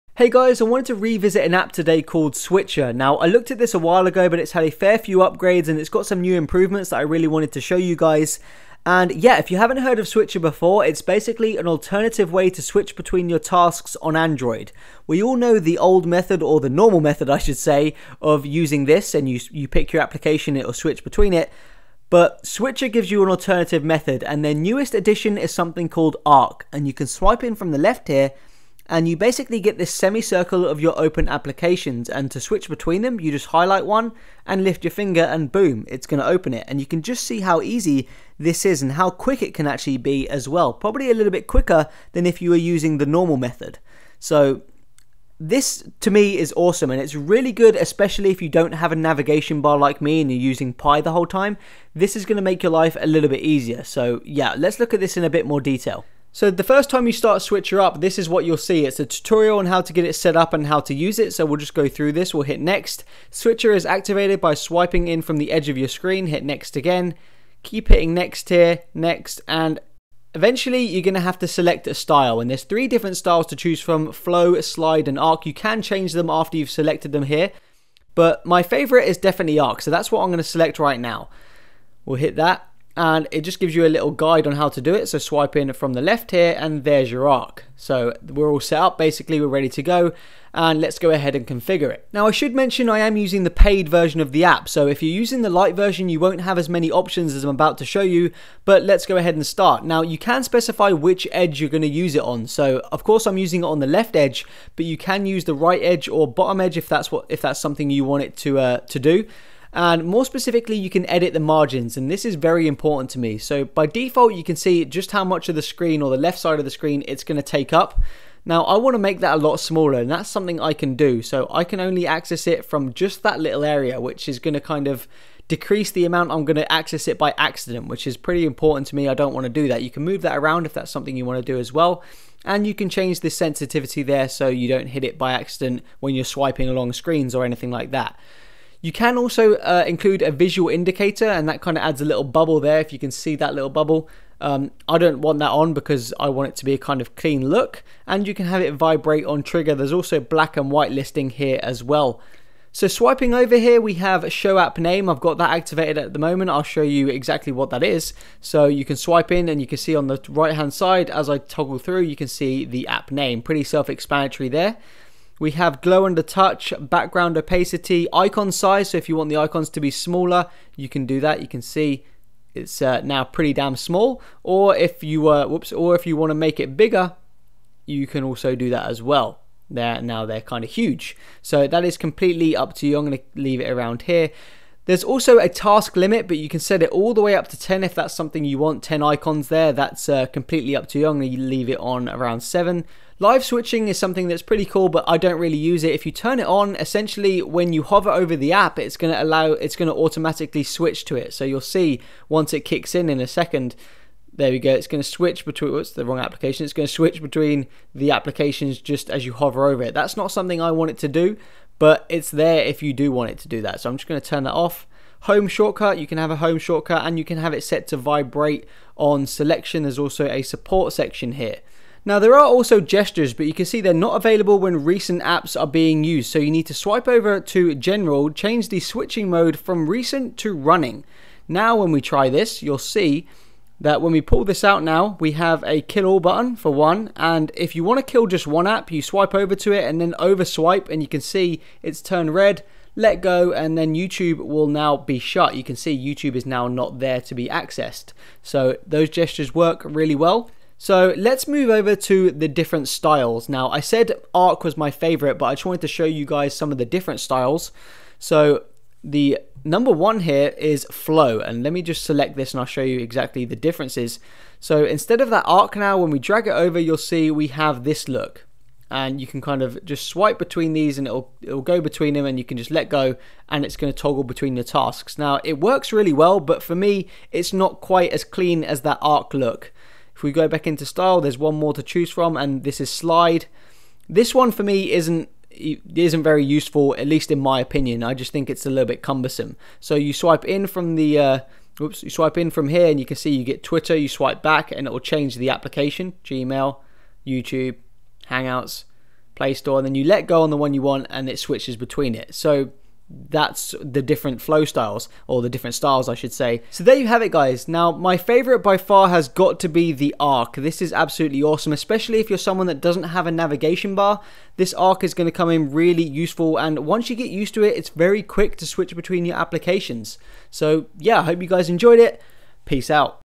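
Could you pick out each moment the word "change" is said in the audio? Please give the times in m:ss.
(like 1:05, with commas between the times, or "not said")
1:15, 2:12, 3:48, 4:54.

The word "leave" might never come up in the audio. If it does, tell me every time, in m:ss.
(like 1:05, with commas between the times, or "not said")
3:03, 3:11.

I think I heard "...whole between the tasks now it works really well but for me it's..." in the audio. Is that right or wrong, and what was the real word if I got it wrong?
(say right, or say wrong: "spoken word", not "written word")
wrong: "toggle", not "whole".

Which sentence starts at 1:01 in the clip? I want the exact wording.
So we'll just go through this, we'll hit next.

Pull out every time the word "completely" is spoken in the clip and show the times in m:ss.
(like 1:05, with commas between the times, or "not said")
3:01, 3:10.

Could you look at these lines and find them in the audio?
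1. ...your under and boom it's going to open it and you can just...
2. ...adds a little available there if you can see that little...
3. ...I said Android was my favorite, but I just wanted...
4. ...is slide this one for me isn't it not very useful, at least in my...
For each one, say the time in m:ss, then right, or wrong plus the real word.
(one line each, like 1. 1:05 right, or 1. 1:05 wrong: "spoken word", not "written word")
1. 0:34 wrong: "finger", not "under"
2. 2:21 wrong: "bubble", not "available"
3. 4:13 wrong: "Arc", not "Android"
4. 4:42 right.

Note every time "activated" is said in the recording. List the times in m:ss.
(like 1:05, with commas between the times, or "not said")
1:03, 2:35.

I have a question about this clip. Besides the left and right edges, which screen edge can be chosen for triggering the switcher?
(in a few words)
Bottom edge.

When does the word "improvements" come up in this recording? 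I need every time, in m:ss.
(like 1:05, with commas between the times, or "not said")
0:06.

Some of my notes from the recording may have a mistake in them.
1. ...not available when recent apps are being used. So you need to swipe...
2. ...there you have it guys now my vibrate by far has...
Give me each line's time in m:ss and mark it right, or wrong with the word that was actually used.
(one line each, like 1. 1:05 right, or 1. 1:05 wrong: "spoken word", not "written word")
1. 3:43 right
2. 5:06 wrong: "favorite", not "vibrate".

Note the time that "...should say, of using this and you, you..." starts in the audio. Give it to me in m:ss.
0:17.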